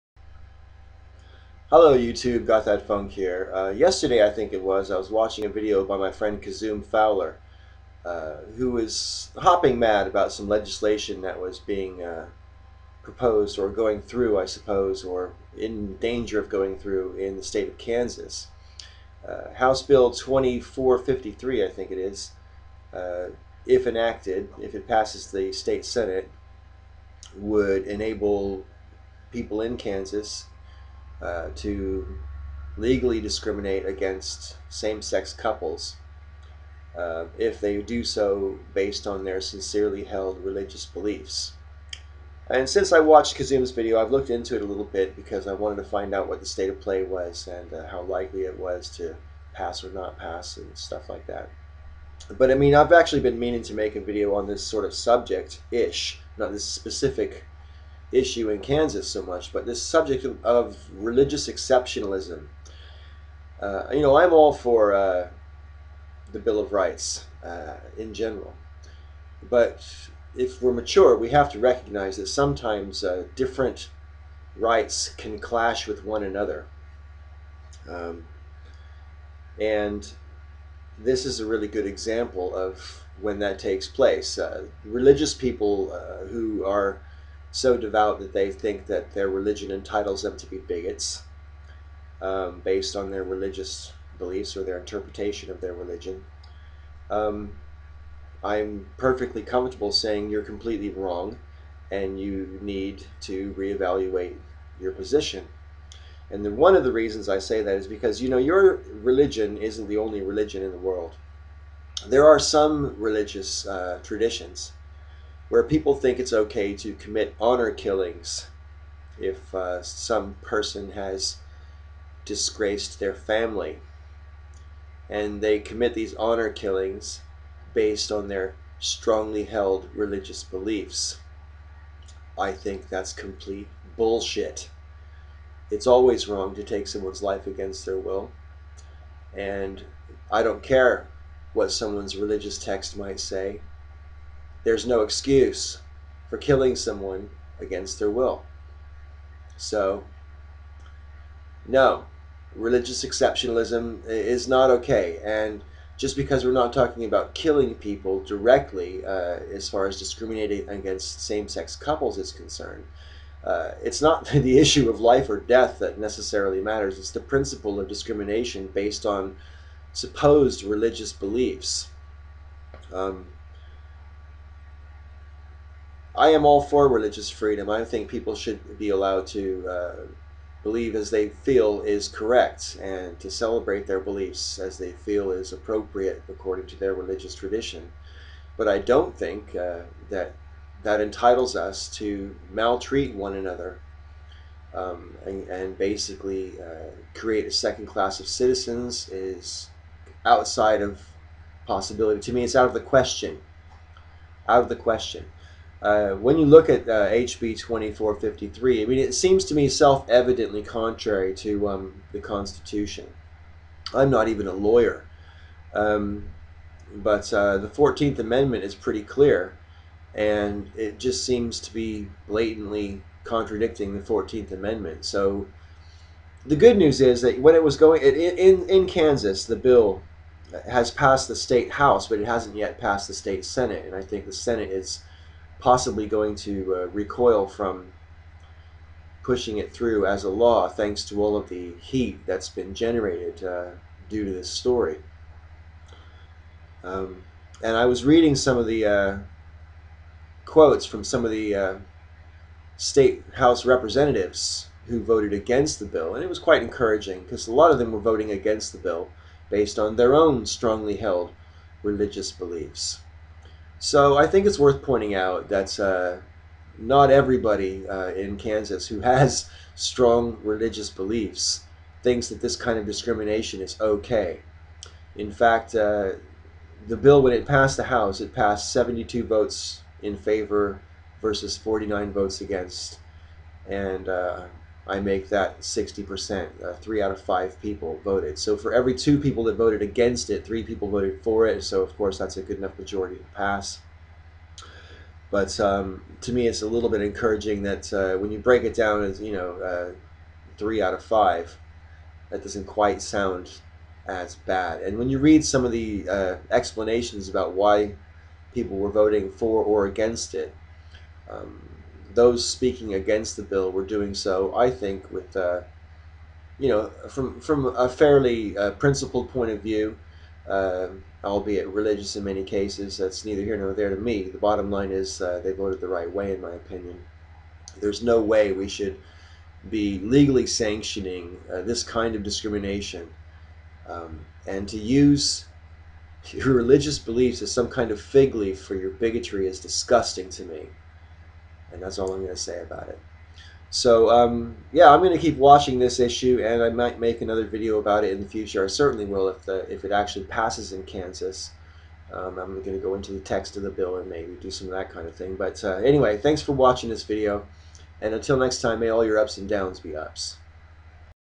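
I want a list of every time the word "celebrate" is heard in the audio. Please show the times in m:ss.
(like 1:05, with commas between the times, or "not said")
3:03.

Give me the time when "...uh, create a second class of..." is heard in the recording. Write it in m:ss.
3:16.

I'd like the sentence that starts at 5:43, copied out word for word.
So um, yeah, I'm going to keep watching this issue, and I might make another video about it in the future.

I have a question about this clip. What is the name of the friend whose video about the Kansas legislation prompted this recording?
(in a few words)
Kazoom Fowler.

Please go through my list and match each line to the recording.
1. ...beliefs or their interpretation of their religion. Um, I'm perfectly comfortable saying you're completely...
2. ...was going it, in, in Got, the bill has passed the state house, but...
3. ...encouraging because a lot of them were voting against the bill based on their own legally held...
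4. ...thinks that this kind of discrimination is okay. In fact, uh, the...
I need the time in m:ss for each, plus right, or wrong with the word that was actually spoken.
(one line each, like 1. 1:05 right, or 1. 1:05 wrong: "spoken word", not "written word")
1. 1:34 right
2. 3:47 wrong: "Kansas", not "Got"
3. 4:16 wrong: "strongly", not "legally"
4. 4:32 right.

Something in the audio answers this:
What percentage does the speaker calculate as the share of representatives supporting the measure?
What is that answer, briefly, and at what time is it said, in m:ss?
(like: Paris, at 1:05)
60%, at 4:45.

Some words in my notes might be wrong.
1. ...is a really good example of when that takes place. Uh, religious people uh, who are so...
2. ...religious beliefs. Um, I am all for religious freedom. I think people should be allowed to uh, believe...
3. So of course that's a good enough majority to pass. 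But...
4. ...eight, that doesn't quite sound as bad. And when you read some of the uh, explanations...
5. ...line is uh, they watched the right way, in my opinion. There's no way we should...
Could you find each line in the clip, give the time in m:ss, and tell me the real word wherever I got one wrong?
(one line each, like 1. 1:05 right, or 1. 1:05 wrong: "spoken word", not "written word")
1. 1:21 right
2. 2:50 right
3. 4:51 right
4. 5:01 wrong: "five", not "eight"
5. 5:24 wrong: "voted", not "watched".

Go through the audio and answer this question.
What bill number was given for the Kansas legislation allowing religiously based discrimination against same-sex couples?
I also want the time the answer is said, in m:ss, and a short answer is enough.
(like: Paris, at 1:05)
House Bill 2453, at 0:19.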